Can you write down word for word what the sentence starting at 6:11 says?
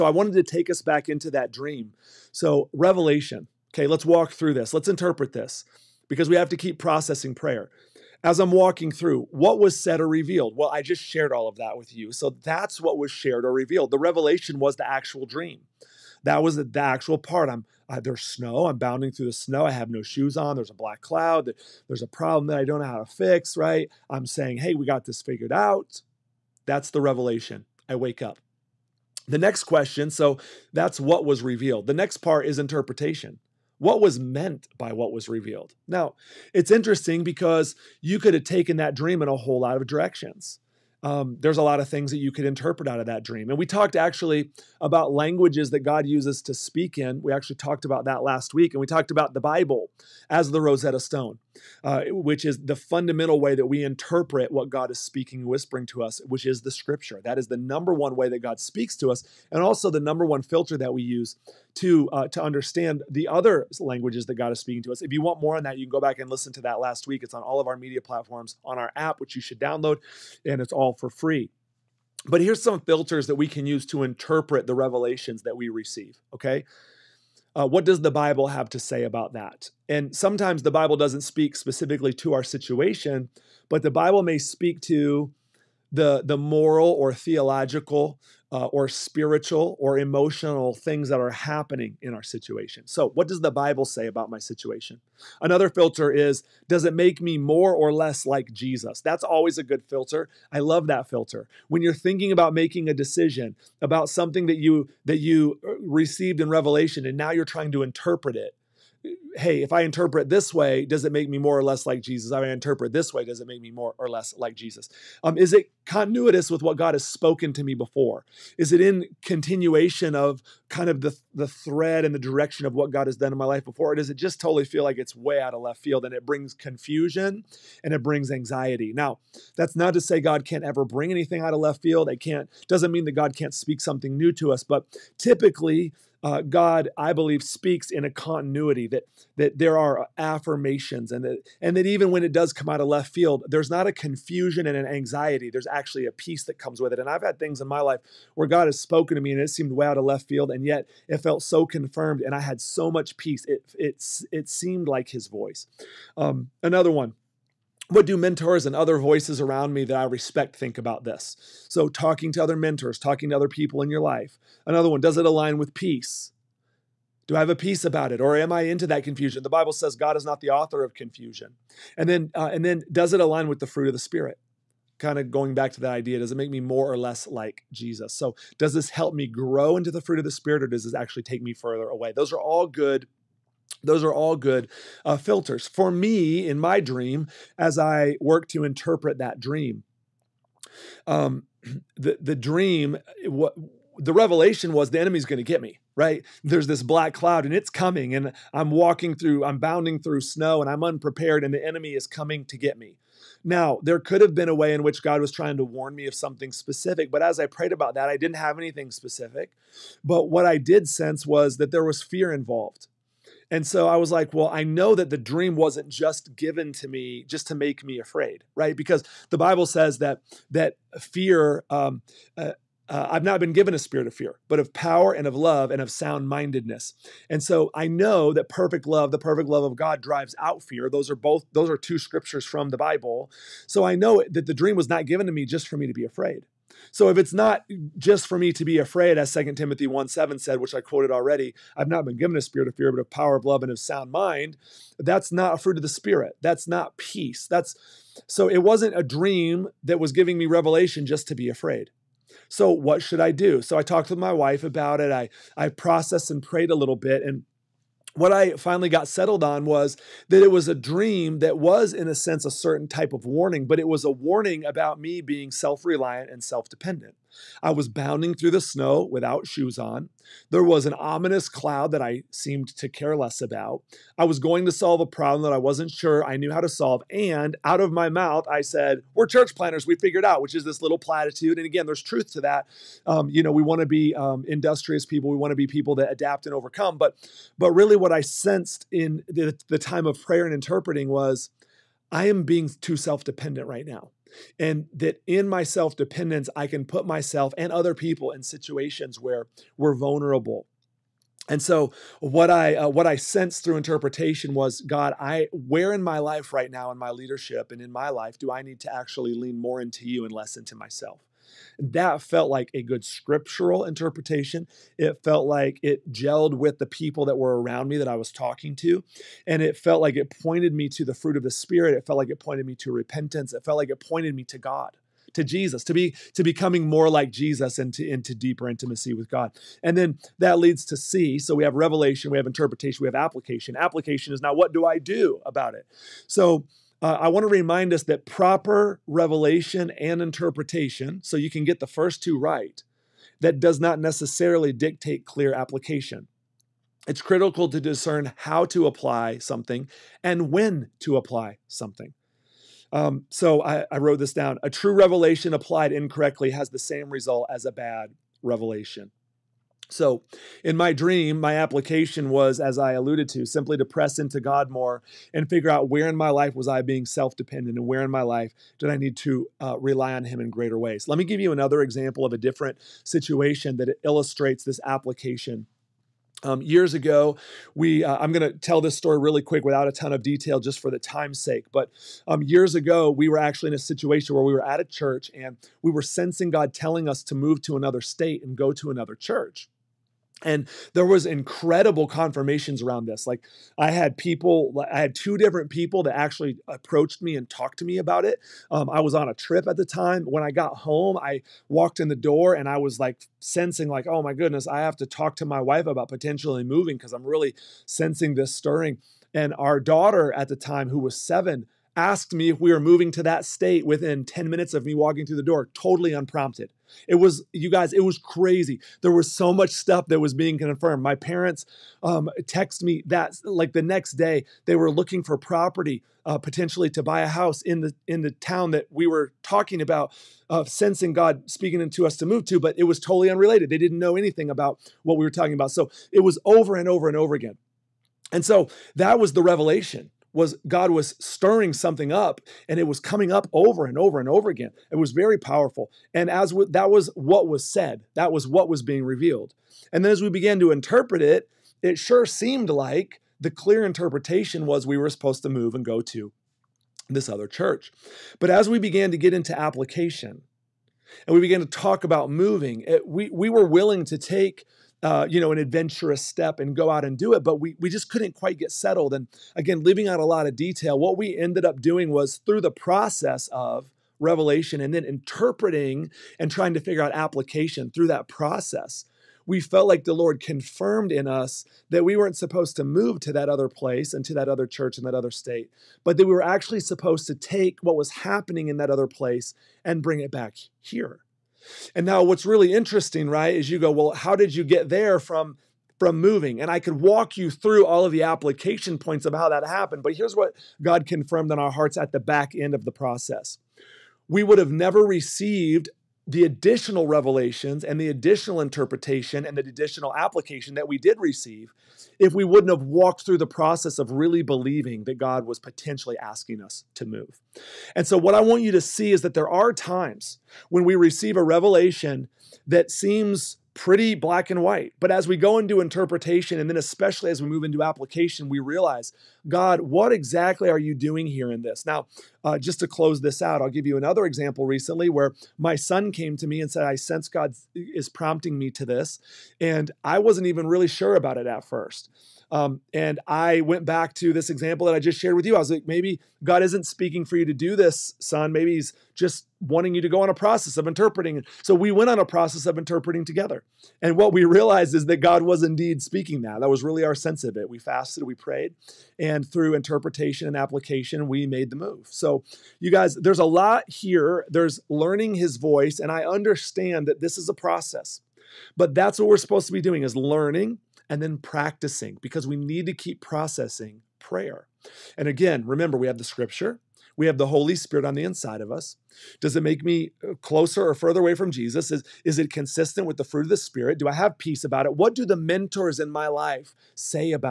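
Let me give you another example of a different situation that illustrates this application.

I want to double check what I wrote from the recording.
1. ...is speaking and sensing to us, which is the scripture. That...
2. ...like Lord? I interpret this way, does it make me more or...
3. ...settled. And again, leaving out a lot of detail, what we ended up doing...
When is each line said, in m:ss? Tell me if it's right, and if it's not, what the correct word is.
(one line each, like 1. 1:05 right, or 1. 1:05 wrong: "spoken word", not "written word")
1. 0:54 wrong: "whispering", not "sensing"
2. 1:51 wrong: "Jesus", not "Lord"
3. 7:48 right.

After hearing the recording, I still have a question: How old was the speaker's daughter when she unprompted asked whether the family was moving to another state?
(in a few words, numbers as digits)
7.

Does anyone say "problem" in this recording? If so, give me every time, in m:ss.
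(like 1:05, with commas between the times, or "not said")
0:22, 4:35.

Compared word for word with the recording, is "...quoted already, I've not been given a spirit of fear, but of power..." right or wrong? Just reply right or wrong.
right.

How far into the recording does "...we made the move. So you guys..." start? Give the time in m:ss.
9:21.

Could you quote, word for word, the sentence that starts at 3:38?
Because the Bible says that that fear.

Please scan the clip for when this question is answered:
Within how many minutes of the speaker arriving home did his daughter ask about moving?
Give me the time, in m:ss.
6:54.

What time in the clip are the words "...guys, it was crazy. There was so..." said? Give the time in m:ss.
6:57.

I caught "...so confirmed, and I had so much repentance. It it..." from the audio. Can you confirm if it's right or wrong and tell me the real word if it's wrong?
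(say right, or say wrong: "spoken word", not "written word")
wrong: "peace", not "repentance".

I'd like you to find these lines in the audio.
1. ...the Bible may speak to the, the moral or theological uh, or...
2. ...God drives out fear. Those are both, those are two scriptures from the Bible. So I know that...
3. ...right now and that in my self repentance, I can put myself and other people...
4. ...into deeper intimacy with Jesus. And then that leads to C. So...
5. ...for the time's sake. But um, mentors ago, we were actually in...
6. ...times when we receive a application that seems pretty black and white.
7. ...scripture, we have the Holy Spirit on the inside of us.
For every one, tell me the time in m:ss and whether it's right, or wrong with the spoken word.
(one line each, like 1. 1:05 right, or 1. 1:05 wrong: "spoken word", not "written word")
1. 1:23 right
2. 3:49 right
3. 4:53 wrong: "dependence", not "repentance"
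4. 5:28 wrong: "God", not "Jesus"
5. 6:20 wrong: "years", not "mentors"
6. 8:39 wrong: "revelation", not "application"
7. 9:36 right.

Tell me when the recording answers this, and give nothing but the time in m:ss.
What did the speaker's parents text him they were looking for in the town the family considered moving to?
7:05.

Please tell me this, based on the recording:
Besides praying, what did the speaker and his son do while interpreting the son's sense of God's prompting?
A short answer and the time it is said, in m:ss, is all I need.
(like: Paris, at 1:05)
Fasted, at 9:17.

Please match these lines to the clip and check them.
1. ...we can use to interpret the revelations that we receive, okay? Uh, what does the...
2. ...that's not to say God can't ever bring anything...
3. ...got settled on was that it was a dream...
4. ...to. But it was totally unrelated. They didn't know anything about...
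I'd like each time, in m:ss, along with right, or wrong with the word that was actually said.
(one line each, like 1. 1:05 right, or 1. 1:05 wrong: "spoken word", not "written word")
1. 1:13 right
2. 2:09 right
3. 4:18 right
4. 7:12 right.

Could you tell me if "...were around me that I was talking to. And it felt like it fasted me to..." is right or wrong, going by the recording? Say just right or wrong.
wrong.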